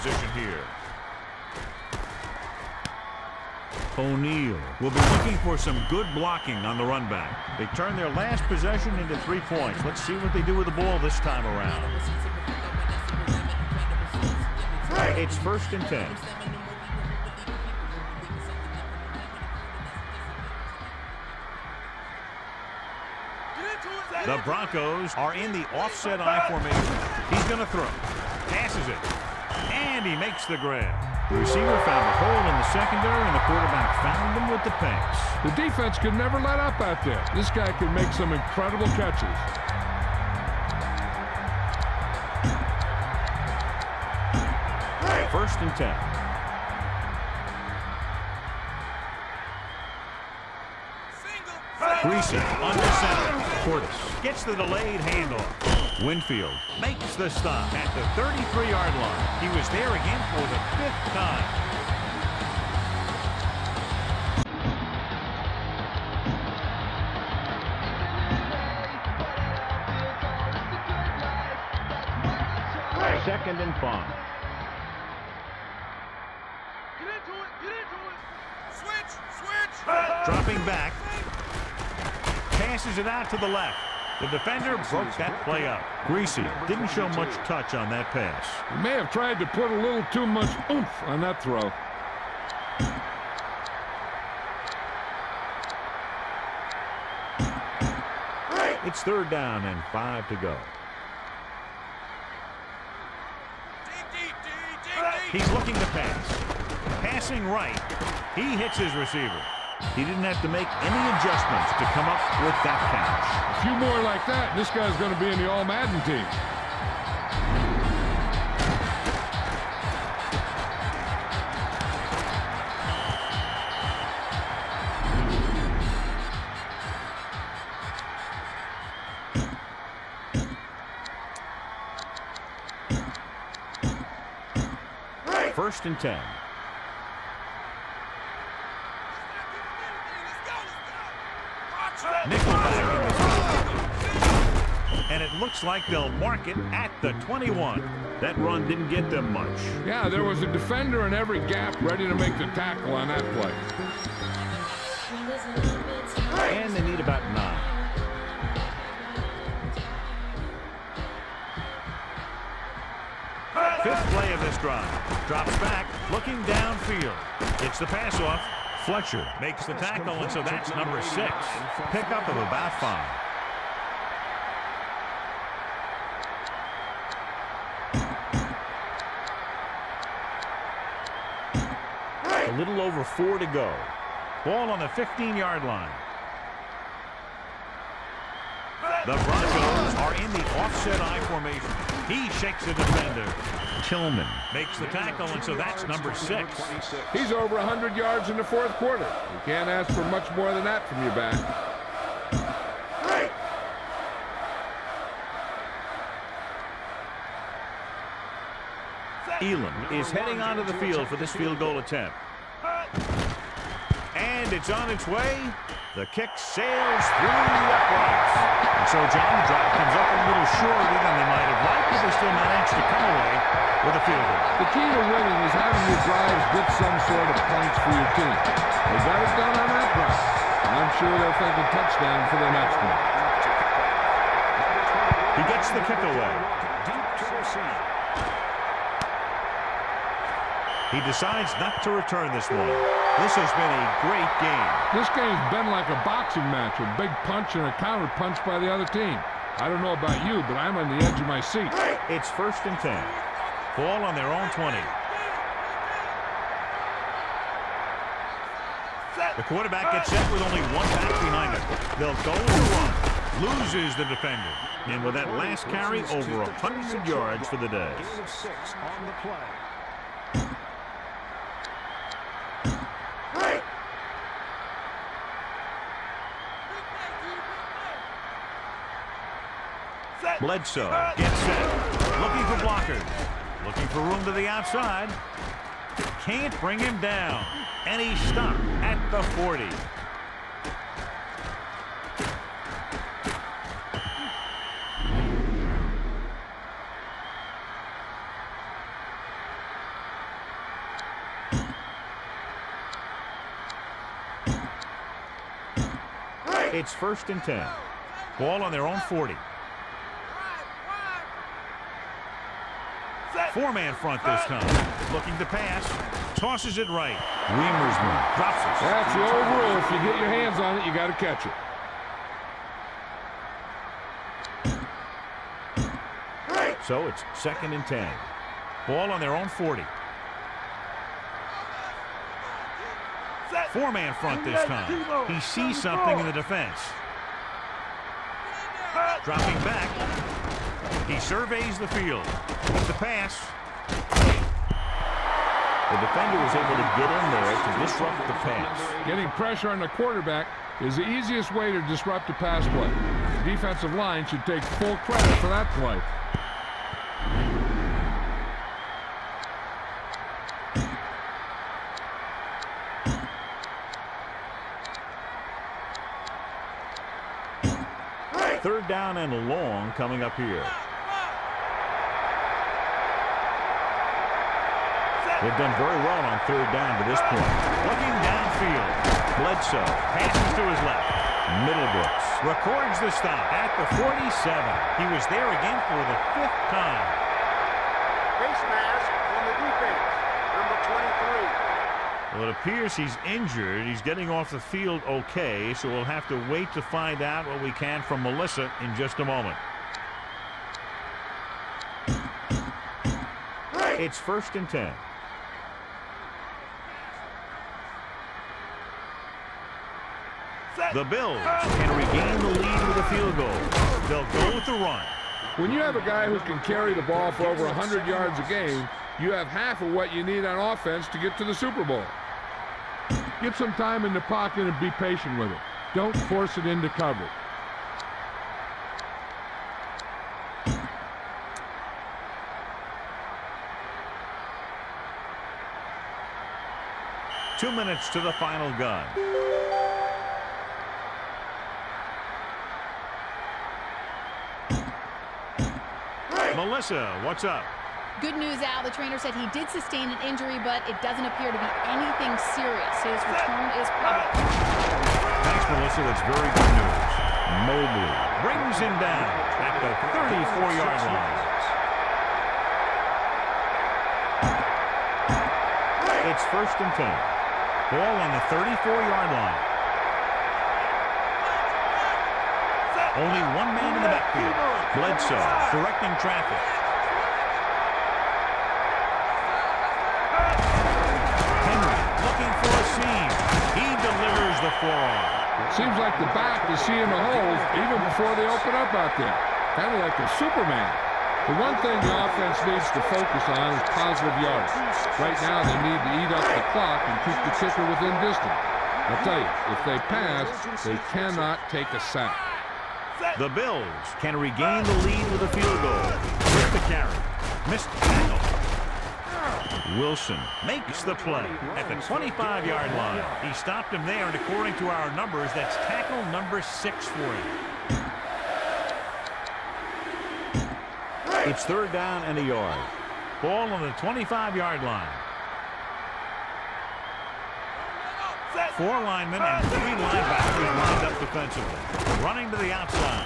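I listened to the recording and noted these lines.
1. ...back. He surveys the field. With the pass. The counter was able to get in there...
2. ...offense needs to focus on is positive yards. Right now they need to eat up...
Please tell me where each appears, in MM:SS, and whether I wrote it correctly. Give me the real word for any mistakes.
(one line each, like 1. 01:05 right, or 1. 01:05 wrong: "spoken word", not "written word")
1. 05:39 wrong: "defender", not "counter"
2. 08:12 right.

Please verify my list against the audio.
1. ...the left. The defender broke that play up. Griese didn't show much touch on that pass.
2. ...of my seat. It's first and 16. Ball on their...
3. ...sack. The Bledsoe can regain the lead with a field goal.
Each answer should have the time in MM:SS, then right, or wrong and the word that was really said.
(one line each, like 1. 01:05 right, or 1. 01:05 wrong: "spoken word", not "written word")
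1. 01:23 right
2. 04:11 wrong: "10", not "16"
3. 08:21 wrong: "Bills", not "Bledsoe".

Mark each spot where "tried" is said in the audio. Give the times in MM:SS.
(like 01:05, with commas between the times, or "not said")
01:29.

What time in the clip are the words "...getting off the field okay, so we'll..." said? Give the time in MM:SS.
06:33.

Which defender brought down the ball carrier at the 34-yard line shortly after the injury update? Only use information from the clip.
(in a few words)
Mobley.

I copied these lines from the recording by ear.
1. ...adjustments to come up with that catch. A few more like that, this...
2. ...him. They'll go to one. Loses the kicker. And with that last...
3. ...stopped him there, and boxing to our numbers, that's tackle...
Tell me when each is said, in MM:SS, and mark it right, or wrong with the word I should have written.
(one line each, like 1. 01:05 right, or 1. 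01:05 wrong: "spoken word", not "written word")
1. 01:51 right
2. 04:21 wrong: "defender", not "kicker"
3. 08:33 wrong: "according", not "boxing".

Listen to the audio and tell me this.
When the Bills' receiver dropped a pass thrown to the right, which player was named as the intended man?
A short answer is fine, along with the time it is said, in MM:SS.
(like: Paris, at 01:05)
Reamer, at 05:17.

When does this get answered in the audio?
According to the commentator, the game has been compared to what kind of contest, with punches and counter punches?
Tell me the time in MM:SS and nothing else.
04:05.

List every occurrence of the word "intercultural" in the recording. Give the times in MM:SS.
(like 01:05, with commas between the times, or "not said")
not said.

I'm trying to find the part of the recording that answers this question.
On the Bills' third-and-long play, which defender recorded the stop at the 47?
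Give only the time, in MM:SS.
06:21.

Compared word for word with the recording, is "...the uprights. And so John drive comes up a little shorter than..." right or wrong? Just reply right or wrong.
right.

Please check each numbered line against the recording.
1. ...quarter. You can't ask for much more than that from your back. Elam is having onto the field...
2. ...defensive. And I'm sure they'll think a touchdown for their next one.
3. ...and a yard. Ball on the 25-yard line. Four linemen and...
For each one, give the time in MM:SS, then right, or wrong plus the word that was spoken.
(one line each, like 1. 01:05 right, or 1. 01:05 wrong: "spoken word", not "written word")
1. 03:18 wrong: "heading", not "having"
2. 03:49 wrong: "drive", not "defensive"
3. 08:42 right.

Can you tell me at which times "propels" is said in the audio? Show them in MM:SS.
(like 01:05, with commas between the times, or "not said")
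not said.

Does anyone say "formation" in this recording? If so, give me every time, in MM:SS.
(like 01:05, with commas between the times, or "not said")
00:26, 03:11.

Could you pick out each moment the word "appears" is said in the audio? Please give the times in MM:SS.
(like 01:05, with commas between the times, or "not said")
06:32, 07:31.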